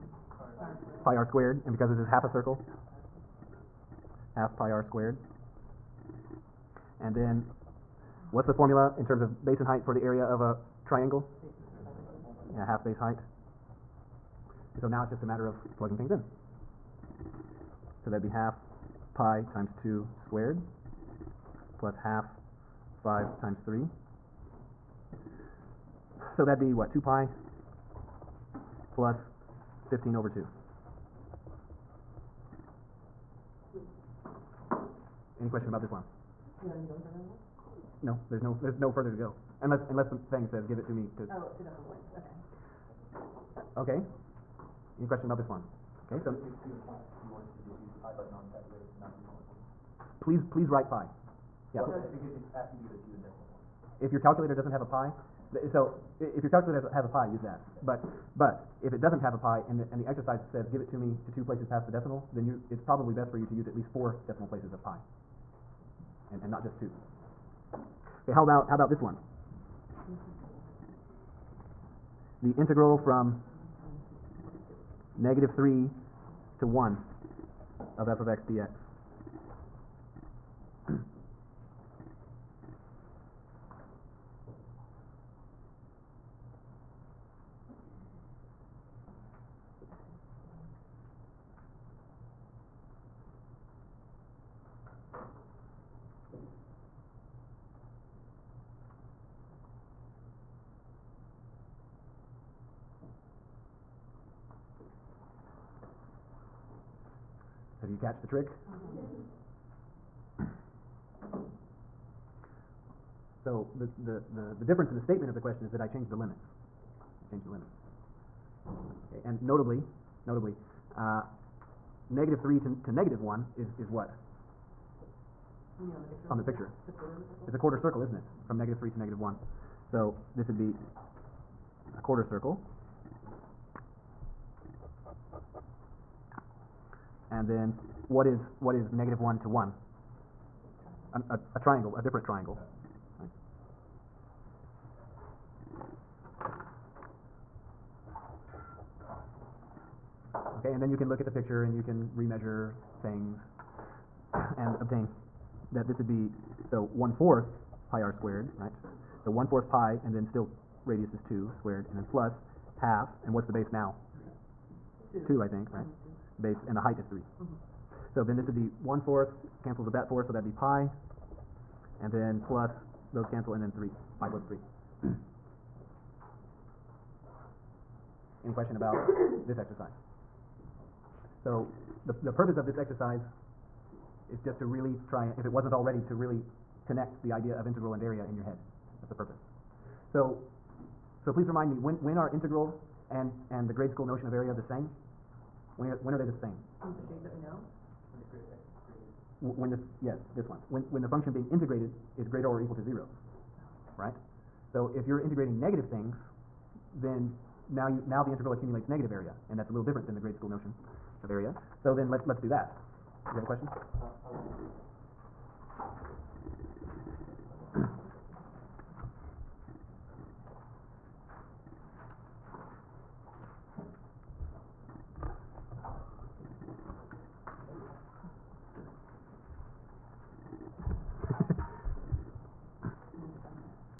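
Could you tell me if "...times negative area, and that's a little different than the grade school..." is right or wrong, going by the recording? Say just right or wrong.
wrong.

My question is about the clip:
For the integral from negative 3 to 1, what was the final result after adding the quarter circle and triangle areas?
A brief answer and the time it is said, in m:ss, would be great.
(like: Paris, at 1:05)
pi plus 3, at 2:54.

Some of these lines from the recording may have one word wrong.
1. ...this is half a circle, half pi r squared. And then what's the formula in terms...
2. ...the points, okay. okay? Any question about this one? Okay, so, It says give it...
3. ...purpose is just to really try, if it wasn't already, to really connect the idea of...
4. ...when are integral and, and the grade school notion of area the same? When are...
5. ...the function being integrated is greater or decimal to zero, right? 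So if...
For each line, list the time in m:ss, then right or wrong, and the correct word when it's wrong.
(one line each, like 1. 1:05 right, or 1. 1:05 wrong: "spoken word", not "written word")
1. 0:01 right
2. 0:41 right
3. 3:02 wrong: "exercise", not "purpose"
4. 3:12 right
5. 3:21 wrong: "equal", not "decimal".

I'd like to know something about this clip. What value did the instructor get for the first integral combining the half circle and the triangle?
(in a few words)
2 pi plus 15/2.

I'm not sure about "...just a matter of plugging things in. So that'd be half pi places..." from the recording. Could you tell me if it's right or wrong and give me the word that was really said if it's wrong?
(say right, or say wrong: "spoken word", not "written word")
wrong: "times", not "places".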